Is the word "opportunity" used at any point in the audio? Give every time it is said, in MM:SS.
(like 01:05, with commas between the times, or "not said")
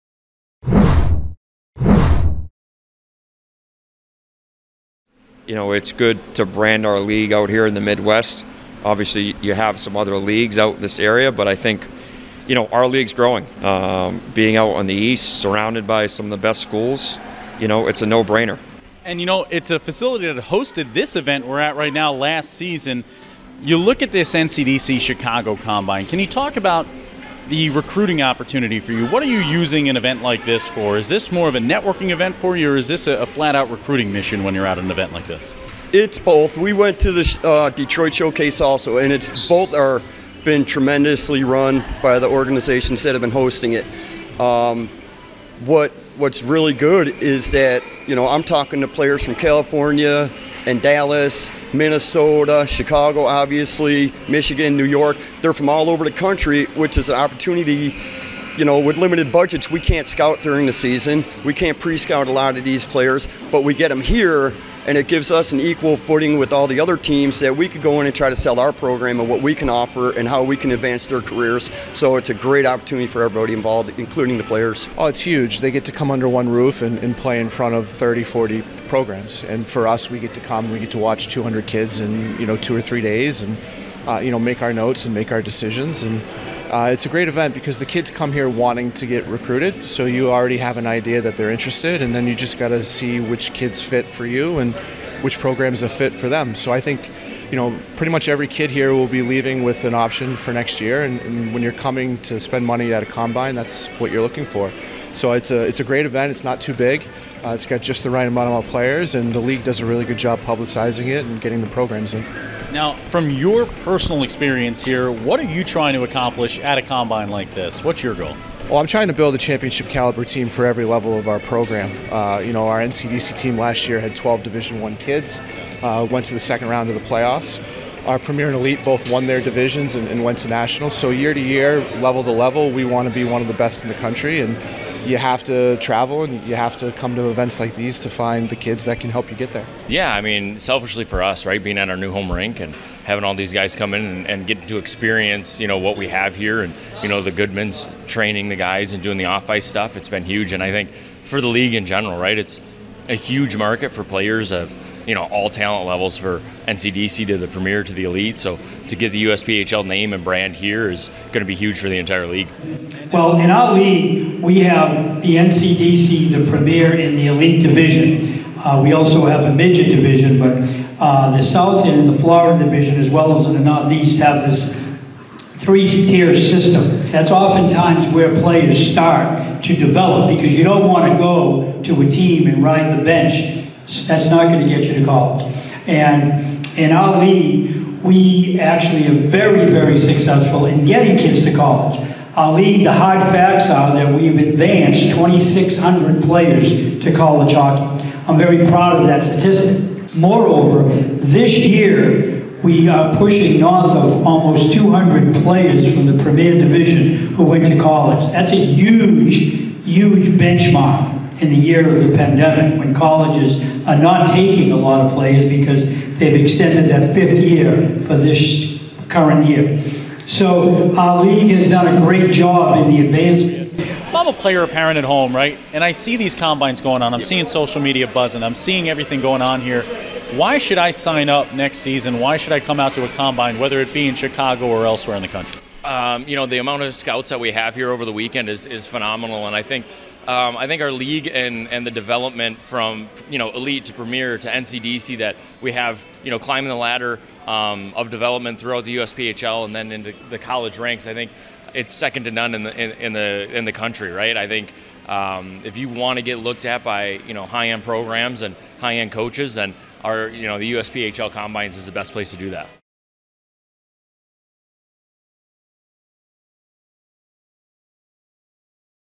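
00:28, 00:57, 01:12.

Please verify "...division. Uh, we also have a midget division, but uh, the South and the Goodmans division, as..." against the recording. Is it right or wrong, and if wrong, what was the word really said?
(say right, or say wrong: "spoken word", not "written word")
wrong: "Florida", not "Goodmans".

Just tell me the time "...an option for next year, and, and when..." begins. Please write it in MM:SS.
01:39.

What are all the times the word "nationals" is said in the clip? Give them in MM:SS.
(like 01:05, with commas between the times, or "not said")
02:10.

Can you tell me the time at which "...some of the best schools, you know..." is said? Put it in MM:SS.
00:16.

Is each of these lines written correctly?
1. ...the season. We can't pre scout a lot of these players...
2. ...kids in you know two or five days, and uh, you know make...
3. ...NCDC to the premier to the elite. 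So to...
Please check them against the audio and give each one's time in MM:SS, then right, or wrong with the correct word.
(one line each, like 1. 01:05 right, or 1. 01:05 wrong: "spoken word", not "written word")
1. 01:00 right
2. 01:21 wrong: "three", not "five"
3. 02:36 right.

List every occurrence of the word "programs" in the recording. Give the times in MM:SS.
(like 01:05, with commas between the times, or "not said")
01:08, 01:18, 01:35, 01:51, 02:01, 04:17.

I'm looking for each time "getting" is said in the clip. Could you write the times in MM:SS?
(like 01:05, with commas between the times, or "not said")
01:51, 03:10.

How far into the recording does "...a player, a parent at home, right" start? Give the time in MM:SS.
03:44.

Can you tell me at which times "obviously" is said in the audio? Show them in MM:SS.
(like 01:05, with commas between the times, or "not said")
00:08, 00:53.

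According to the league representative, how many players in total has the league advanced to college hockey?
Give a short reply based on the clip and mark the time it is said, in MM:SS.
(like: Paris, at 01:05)
2,600, at 03:15.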